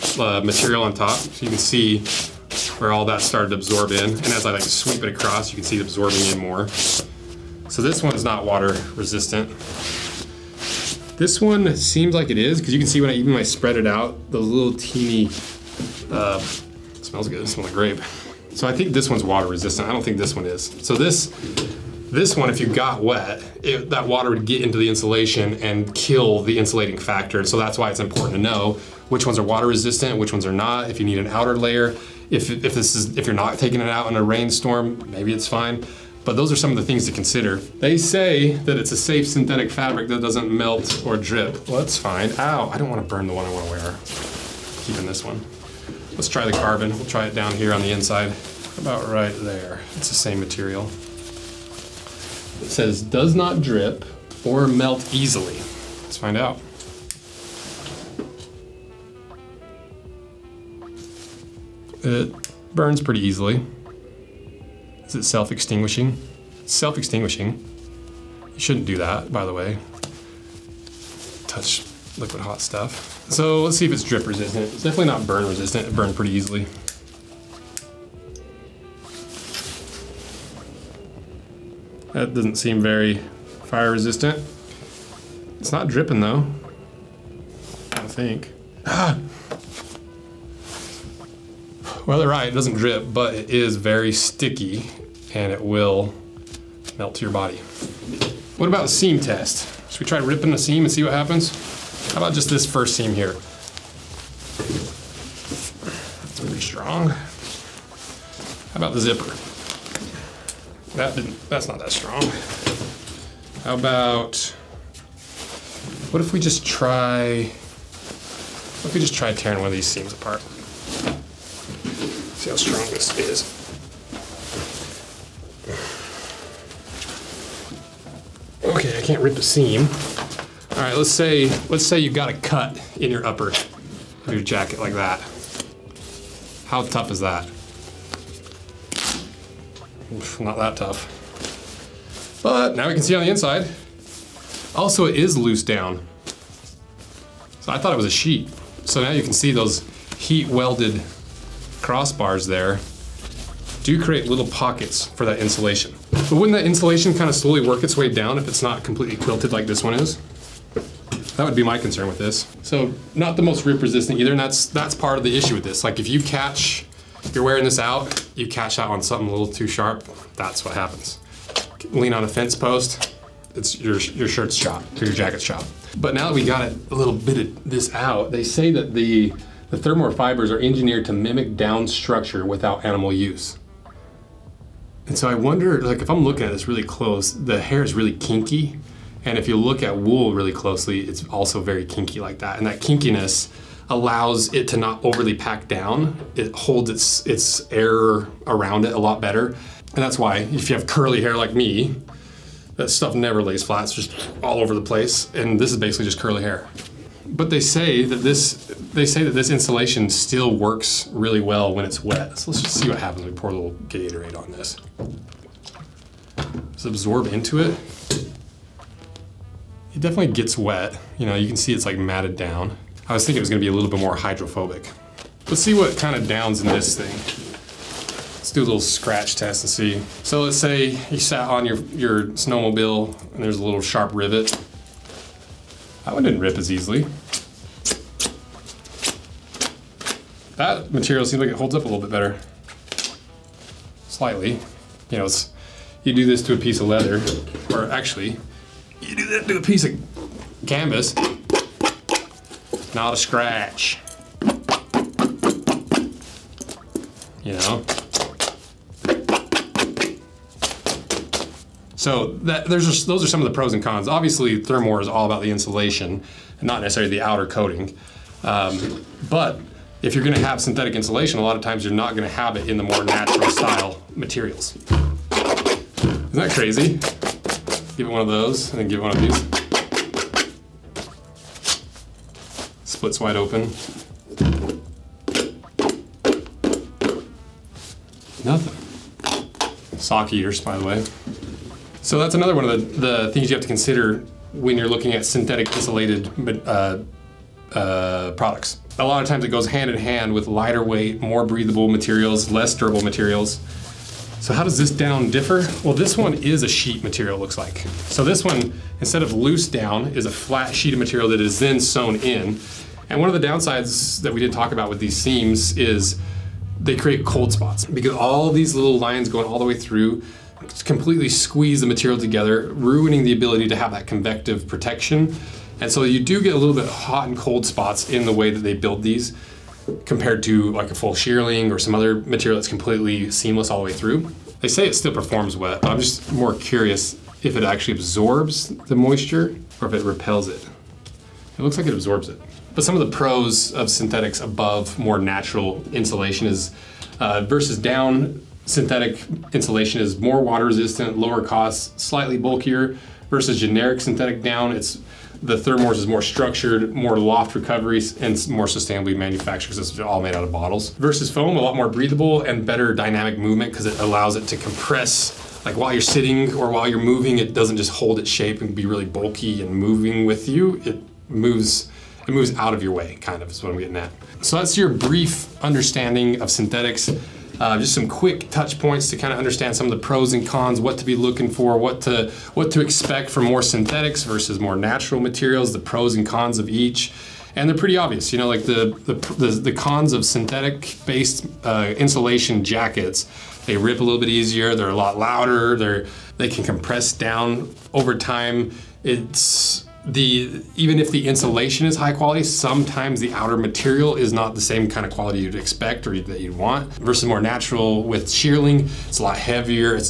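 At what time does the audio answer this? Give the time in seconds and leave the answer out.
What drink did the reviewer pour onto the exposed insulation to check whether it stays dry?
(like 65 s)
213 s.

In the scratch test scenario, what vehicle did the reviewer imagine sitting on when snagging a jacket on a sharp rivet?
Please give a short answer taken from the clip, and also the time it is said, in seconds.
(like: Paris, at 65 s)
snowmobile, at 232 s.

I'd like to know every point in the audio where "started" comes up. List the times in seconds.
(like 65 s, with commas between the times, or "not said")
3 s.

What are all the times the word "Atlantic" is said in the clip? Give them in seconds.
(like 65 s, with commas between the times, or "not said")
not said.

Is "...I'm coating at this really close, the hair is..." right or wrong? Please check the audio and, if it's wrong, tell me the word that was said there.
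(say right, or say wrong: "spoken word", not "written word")
wrong: "looking", not "coating".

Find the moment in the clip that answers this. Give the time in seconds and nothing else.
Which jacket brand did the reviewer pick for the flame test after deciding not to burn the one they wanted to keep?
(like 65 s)
46 s.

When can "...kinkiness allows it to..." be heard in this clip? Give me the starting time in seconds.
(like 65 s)
192 s.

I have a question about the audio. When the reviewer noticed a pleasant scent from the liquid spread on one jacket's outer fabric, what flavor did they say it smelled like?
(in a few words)
grape.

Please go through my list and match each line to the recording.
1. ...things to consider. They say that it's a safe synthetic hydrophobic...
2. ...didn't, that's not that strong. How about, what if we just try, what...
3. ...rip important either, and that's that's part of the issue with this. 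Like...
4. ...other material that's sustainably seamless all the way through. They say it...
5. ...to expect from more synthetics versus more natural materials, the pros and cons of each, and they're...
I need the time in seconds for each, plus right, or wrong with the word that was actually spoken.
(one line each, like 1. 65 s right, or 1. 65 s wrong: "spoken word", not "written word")
1. 36 s wrong: "fabric", not "hydrophobic"
2. 111 s right
3. 163 s wrong: "resistant", not "important"
4. 331 s wrong: "completely", not "sustainably"
5. 382 s right.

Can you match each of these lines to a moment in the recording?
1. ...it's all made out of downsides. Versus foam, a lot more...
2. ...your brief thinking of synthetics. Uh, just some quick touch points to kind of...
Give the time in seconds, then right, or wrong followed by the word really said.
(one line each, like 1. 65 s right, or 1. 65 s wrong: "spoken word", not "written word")
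1. 359 s wrong: "bottles", not "downsides"
2. 374 s wrong: "understanding", not "thinking".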